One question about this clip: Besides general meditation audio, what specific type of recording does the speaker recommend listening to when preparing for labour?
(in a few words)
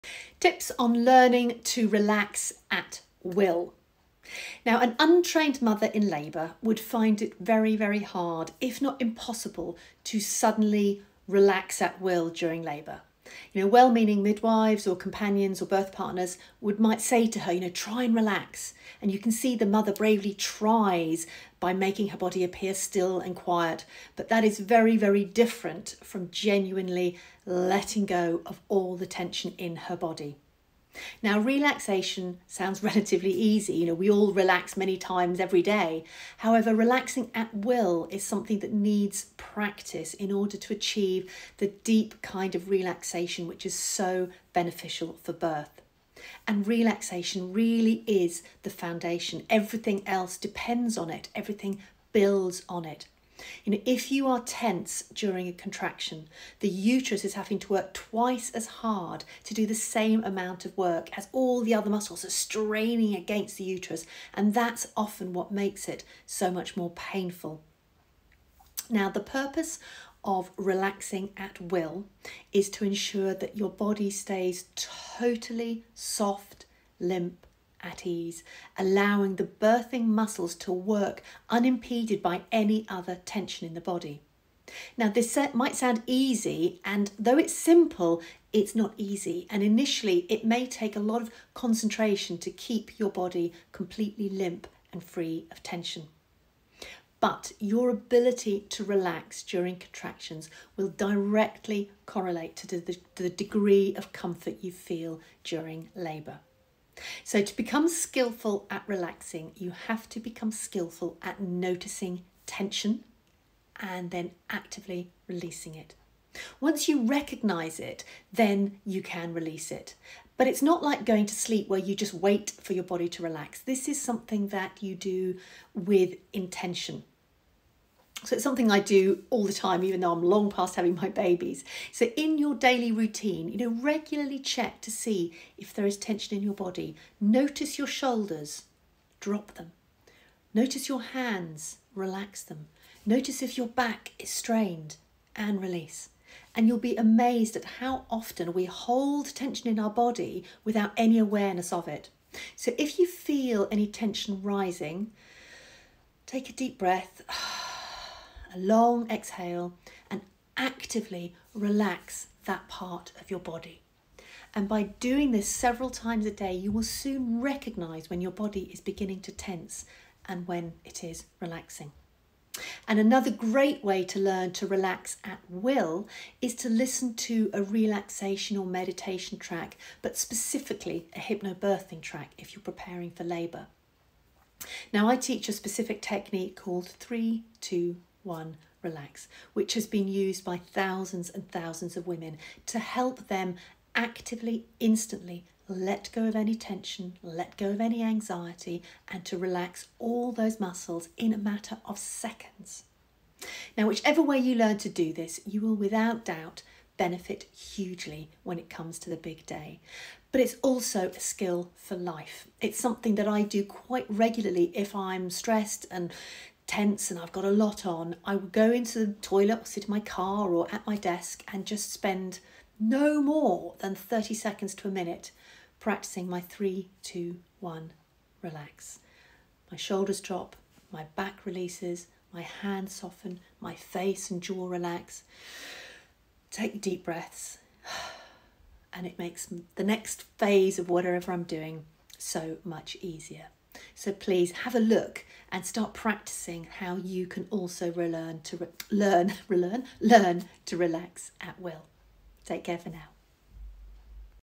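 hypnobirthing track.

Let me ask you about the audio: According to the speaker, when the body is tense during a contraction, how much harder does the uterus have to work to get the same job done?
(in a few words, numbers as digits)
twice as hard.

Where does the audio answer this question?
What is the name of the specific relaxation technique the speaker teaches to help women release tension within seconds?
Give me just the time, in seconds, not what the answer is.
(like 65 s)
186 s.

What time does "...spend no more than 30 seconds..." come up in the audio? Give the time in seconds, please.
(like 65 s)
221 s.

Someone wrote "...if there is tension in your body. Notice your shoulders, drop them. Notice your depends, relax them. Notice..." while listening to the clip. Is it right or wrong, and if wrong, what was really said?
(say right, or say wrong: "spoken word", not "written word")
wrong: "hands", not "depends".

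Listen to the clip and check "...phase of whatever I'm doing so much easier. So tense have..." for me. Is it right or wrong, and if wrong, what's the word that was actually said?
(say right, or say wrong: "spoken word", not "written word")
wrong: "please", not "tense".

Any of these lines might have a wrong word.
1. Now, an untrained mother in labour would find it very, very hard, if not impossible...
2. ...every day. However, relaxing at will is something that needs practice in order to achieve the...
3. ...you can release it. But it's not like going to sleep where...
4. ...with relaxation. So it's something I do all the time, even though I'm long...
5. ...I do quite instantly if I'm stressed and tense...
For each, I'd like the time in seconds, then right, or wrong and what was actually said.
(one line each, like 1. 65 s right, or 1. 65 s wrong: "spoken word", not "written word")
1. 4 s right
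2. 35 s right
3. 118 s right
4. 125 s wrong: "intention", not "relaxation"
5. 213 s wrong: "regularly", not "instantly".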